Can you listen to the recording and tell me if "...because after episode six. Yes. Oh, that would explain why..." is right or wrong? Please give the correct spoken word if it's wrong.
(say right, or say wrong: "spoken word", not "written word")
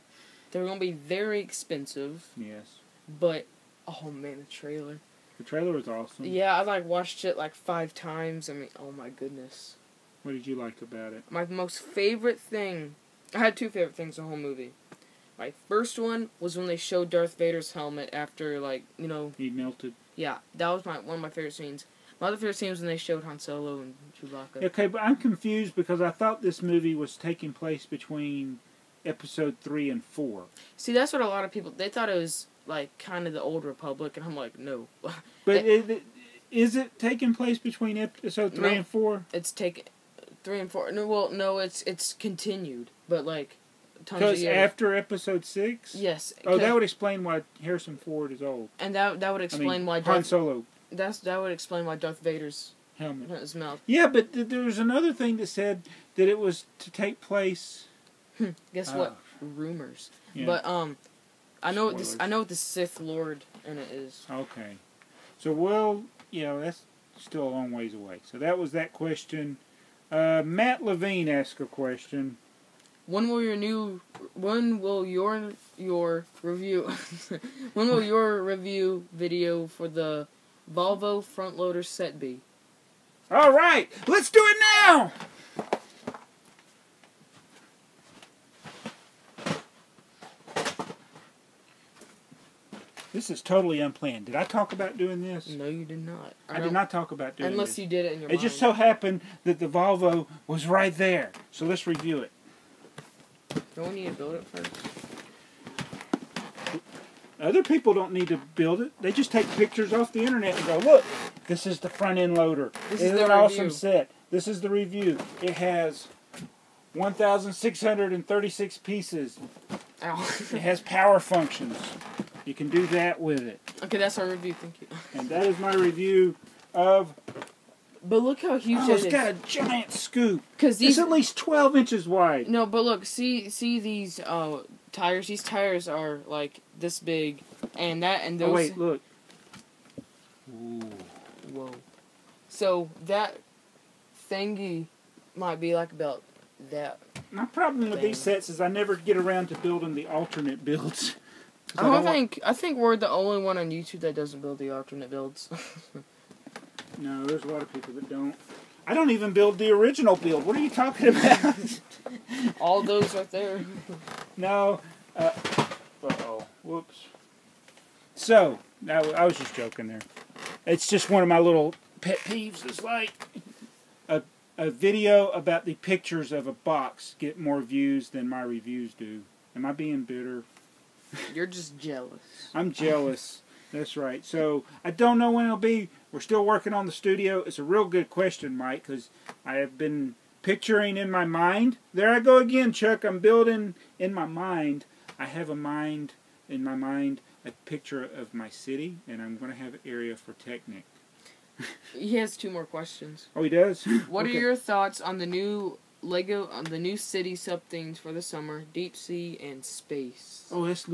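right.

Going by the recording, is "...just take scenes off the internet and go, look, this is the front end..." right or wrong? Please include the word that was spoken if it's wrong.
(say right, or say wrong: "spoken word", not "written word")
wrong: "pictures", not "scenes".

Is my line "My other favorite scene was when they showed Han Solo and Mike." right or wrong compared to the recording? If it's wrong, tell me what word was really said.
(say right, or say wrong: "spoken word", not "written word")
wrong: "Chewbacca", not "Mike".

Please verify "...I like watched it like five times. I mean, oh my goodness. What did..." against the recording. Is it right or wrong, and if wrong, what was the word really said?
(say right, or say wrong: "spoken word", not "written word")
right.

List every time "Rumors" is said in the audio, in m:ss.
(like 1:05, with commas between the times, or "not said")
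0:59.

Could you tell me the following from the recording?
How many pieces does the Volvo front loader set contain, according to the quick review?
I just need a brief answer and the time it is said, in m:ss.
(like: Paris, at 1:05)
1,636, at 1:56.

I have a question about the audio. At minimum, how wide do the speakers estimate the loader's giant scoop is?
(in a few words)
12 inches.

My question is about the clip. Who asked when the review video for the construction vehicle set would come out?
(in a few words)
Matt Lavene.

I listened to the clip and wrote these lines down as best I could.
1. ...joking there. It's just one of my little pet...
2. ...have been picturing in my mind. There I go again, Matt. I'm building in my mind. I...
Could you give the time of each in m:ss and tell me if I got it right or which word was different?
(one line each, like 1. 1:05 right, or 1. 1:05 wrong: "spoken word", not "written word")
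1. 2:49 right
2. 3:09 wrong: "Chuck", not "Matt".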